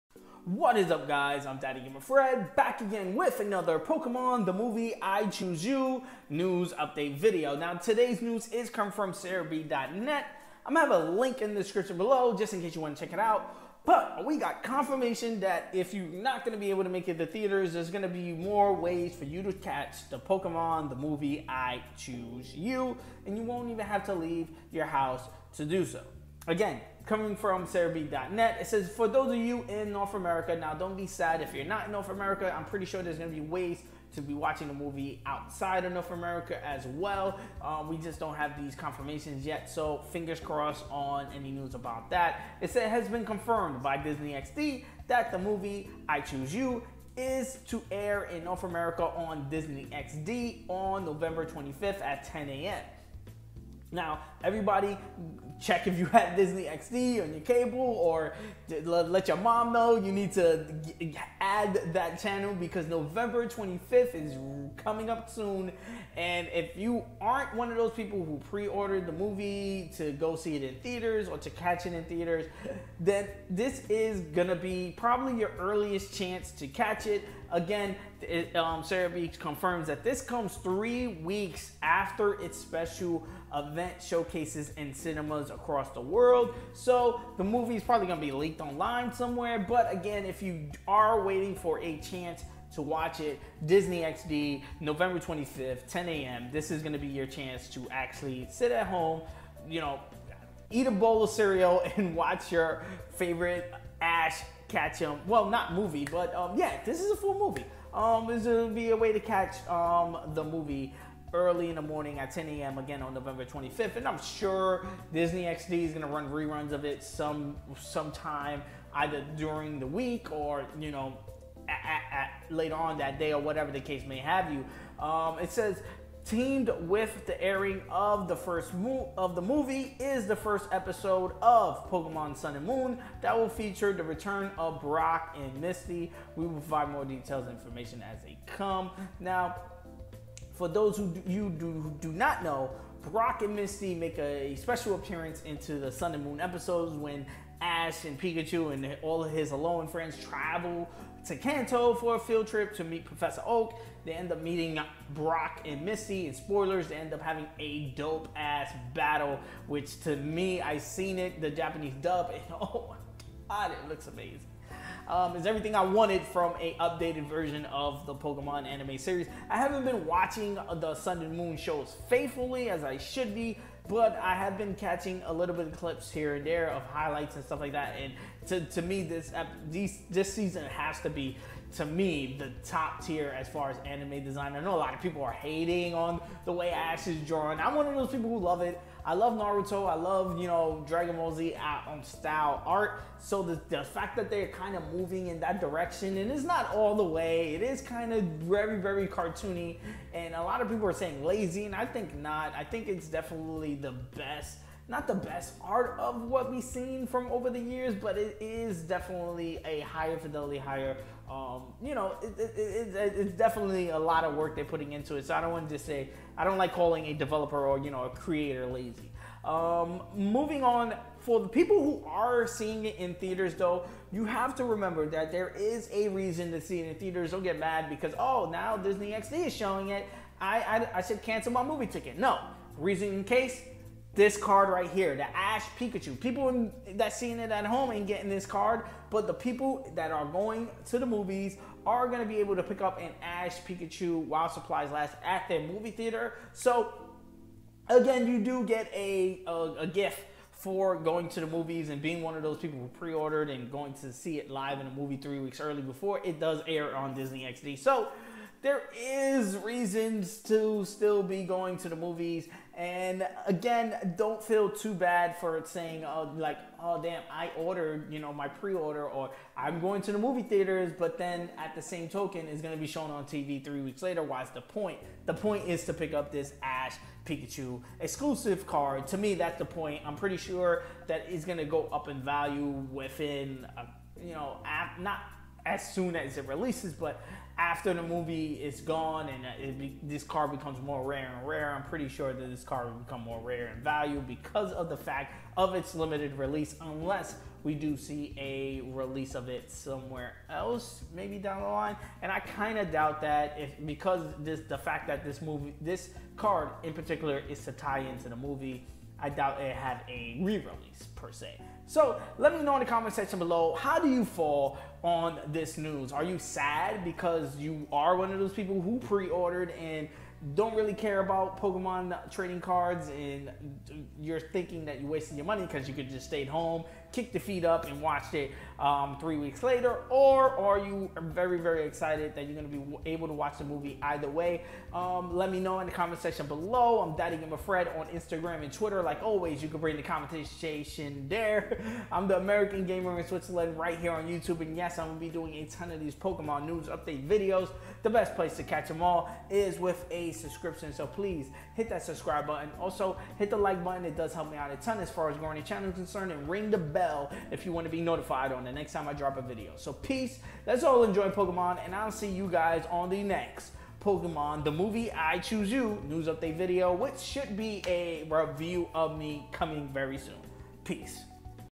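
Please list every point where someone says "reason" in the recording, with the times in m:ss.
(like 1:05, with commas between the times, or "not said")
3:46, 3:52, 4:19.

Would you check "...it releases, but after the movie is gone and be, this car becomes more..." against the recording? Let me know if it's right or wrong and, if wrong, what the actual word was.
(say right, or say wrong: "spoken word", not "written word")
right.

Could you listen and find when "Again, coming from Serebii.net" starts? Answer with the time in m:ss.
0:26.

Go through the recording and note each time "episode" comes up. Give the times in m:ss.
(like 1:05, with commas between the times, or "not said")
2:10, 2:26.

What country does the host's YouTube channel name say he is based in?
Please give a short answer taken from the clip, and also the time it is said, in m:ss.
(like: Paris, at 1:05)
Switzerland, at 5:43.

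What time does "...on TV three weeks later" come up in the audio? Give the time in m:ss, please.
4:33.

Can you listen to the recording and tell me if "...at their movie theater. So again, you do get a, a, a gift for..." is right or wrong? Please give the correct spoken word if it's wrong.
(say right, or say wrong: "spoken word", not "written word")
right.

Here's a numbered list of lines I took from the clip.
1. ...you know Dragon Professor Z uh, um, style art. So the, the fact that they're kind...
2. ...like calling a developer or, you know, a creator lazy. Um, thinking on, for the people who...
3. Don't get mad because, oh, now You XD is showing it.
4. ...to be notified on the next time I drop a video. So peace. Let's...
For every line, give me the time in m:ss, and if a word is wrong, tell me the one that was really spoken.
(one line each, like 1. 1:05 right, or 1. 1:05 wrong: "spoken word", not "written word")
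1. 3:10 wrong: "Ball", not "Professor"
2. 3:36 wrong: "moving", not "thinking"
3. 3:47 wrong: "Disney", not "You"
4. 5:57 right.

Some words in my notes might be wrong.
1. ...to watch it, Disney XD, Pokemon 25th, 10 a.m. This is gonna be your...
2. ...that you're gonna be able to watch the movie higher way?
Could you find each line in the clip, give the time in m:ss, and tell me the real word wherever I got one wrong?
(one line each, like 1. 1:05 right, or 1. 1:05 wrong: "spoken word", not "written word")
1. 1:32 wrong: "November", not "Pokemon"
2. 5:32 wrong: "either", not "higher".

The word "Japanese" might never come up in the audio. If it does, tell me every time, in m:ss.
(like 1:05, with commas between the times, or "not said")
2:41.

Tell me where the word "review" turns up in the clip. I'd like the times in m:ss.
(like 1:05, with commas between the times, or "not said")
6:08.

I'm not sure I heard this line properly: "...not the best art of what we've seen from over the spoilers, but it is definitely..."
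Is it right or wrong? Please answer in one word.
wrong.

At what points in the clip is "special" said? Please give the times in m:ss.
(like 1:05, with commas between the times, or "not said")
1:22, 2:24.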